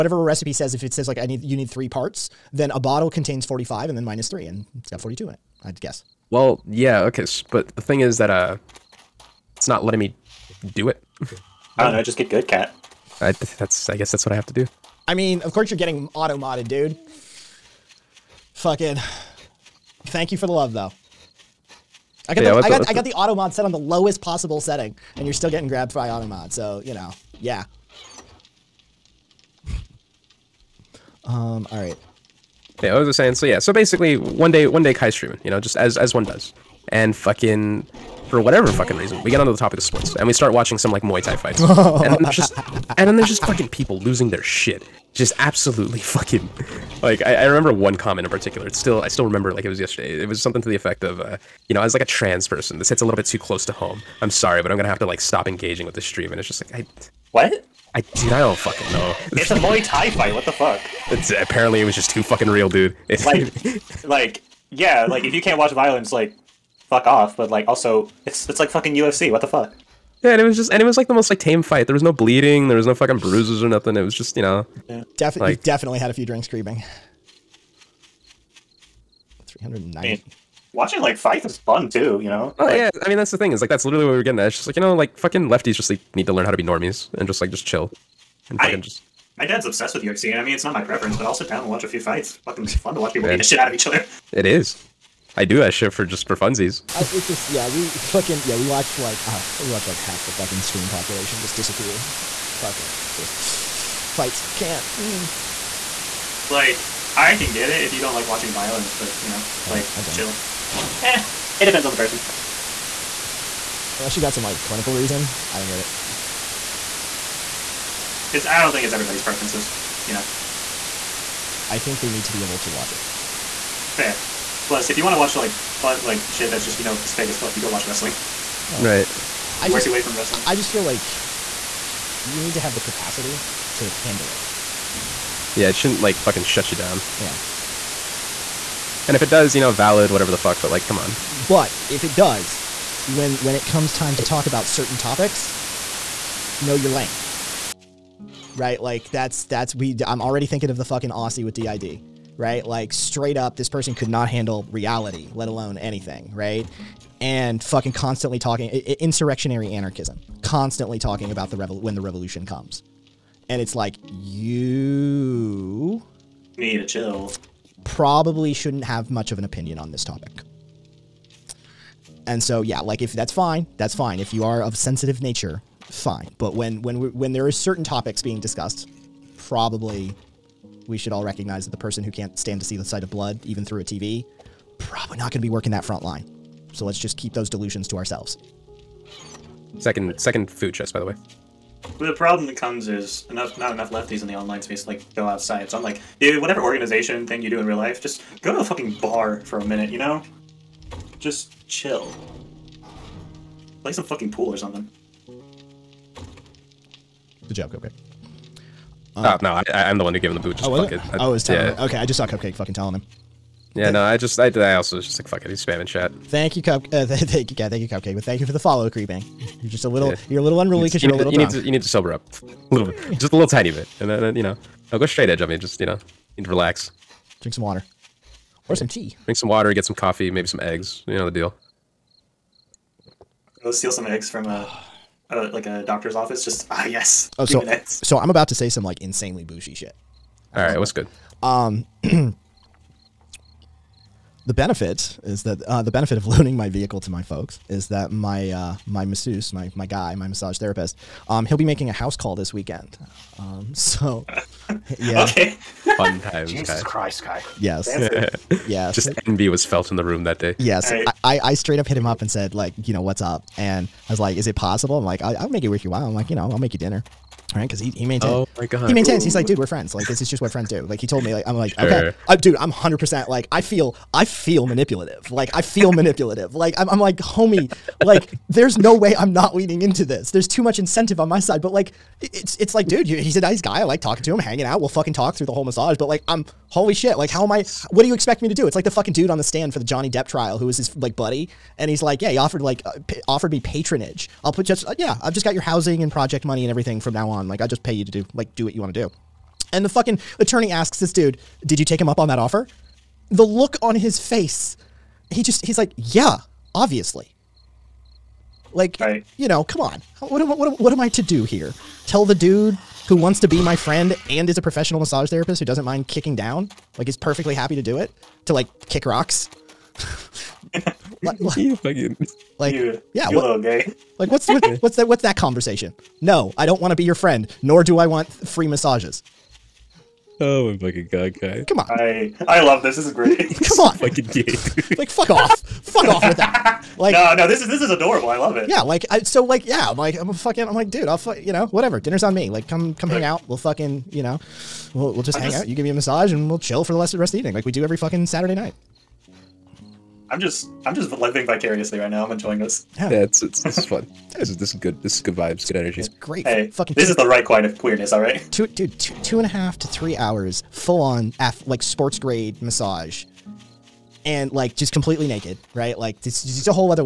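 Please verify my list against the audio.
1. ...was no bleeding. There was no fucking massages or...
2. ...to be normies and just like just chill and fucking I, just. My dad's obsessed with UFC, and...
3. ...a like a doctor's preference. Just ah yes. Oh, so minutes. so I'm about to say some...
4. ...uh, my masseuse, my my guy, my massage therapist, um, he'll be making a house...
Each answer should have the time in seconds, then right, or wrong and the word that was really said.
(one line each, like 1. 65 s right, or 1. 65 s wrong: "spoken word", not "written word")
1. 71 s wrong: "bruises", not "massages"
2. 86 s right
3. 235 s wrong: "office", not "preference"
4. 248 s right.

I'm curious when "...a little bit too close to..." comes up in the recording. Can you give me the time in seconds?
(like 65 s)
53 s.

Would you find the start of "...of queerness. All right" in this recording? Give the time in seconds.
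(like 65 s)
357 s.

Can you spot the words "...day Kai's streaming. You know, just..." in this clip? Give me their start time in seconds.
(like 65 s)
34 s.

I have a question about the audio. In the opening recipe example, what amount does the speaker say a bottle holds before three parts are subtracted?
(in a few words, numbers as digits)
45.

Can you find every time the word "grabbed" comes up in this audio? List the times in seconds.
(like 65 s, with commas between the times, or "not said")
25 s.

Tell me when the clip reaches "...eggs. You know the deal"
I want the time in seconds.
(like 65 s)
230 s.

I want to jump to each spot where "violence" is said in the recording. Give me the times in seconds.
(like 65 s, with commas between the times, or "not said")
65 s, 108 s.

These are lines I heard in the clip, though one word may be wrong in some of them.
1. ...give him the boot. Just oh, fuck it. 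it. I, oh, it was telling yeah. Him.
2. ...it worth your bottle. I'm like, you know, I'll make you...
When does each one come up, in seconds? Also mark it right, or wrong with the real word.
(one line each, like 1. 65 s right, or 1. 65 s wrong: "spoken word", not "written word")
1. 210 s right
2. 265 s wrong: "while", not "bottle".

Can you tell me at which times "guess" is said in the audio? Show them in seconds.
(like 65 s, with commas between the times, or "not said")
5 s, 13 s.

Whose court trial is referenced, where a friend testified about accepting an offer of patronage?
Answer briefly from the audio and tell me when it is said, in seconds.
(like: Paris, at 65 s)
Johnny Depp, at 289 s.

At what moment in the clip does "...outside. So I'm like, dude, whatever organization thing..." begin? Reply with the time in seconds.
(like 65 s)
195 s.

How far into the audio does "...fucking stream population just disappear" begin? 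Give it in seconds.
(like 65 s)
100 s.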